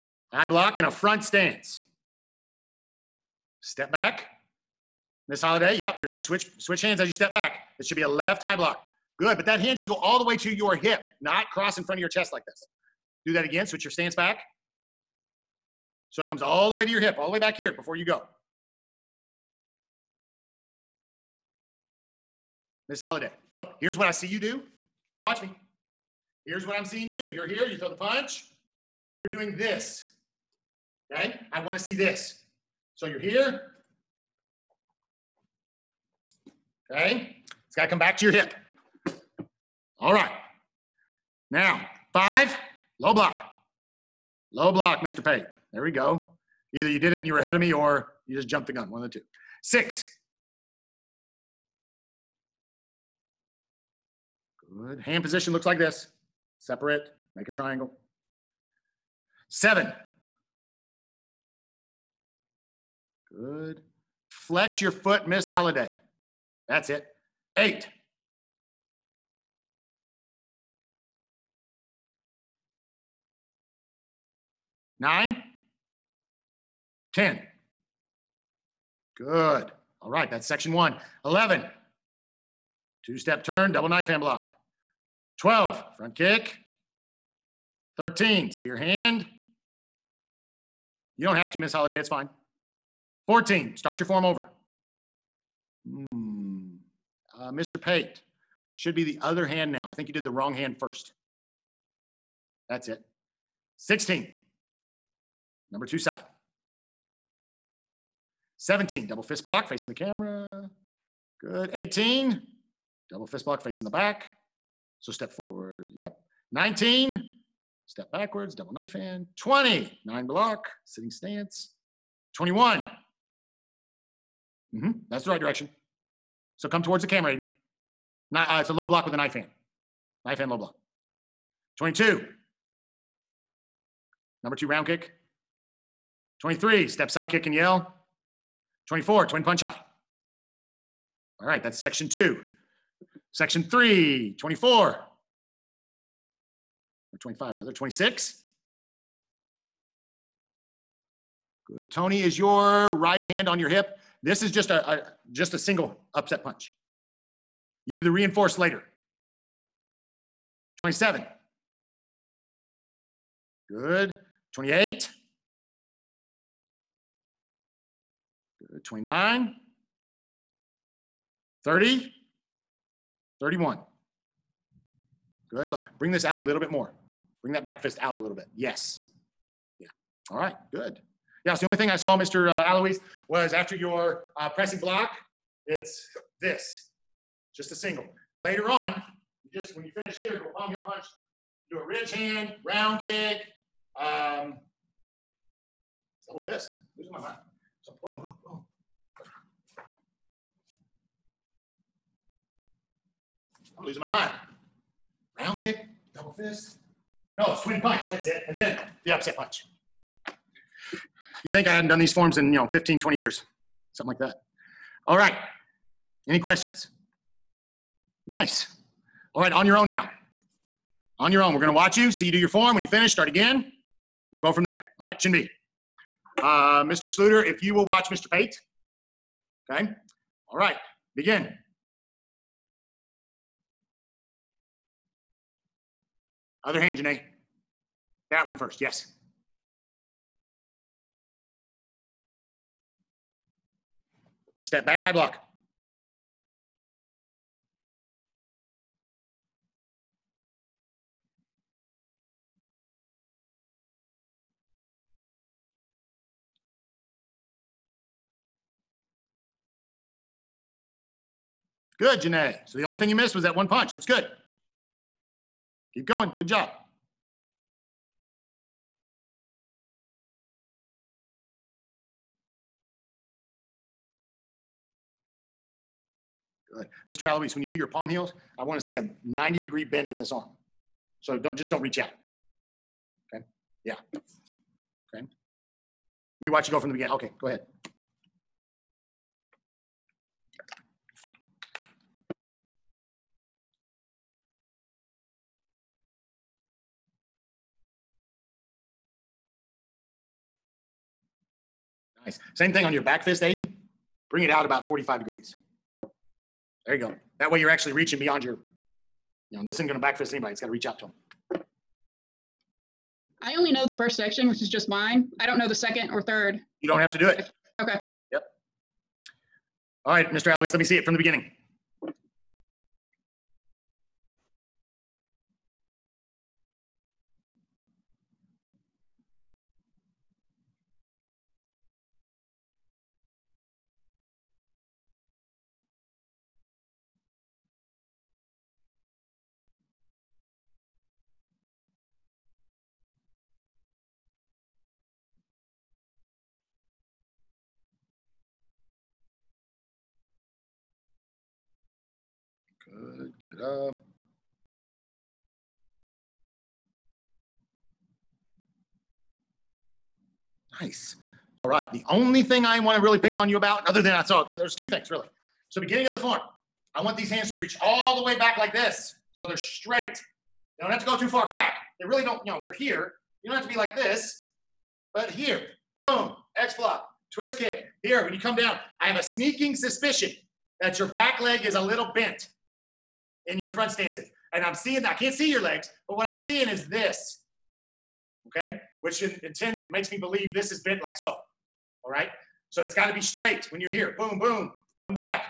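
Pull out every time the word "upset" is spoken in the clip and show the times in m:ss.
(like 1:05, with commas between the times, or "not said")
2:36, 3:29.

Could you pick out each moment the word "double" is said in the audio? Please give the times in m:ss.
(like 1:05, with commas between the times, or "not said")
1:23, 1:49, 1:53, 1:58, 3:16, 3:26.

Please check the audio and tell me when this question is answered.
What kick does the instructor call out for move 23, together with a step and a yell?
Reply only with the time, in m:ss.
2:17.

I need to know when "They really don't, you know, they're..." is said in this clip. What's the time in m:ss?
6:11.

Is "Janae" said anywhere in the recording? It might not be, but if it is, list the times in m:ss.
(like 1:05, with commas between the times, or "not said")
3:56, 4:22.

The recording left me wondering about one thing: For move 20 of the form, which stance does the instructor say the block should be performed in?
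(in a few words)
Sitting stance.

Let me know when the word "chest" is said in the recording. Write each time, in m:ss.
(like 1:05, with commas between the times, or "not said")
0:12.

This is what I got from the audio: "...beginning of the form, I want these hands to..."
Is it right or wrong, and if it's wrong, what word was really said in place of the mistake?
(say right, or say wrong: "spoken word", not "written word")
right.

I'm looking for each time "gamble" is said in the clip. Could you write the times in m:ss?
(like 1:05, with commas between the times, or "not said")
not said.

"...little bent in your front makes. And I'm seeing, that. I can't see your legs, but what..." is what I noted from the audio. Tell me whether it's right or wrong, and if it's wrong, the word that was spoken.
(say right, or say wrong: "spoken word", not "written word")
wrong: "stances", not "makes".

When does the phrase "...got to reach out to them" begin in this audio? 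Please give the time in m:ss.
5:10.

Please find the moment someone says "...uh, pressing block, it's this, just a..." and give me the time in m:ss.
3:04.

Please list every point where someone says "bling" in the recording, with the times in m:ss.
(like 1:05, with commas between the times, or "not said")
not said.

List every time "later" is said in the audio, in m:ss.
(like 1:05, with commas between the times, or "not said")
2:38, 3:08.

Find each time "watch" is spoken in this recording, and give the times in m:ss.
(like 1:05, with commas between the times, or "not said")
0:25, 3:41, 3:47, 4:46.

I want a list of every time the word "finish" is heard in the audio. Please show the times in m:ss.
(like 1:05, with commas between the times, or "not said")
3:09, 3:42.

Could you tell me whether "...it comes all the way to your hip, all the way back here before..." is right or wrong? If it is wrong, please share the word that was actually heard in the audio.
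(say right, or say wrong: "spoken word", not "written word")
right.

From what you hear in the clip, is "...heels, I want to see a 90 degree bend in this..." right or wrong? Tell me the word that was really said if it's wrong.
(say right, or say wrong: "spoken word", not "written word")
right.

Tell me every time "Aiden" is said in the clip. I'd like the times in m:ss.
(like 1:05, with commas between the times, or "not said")
2:07, 5:03.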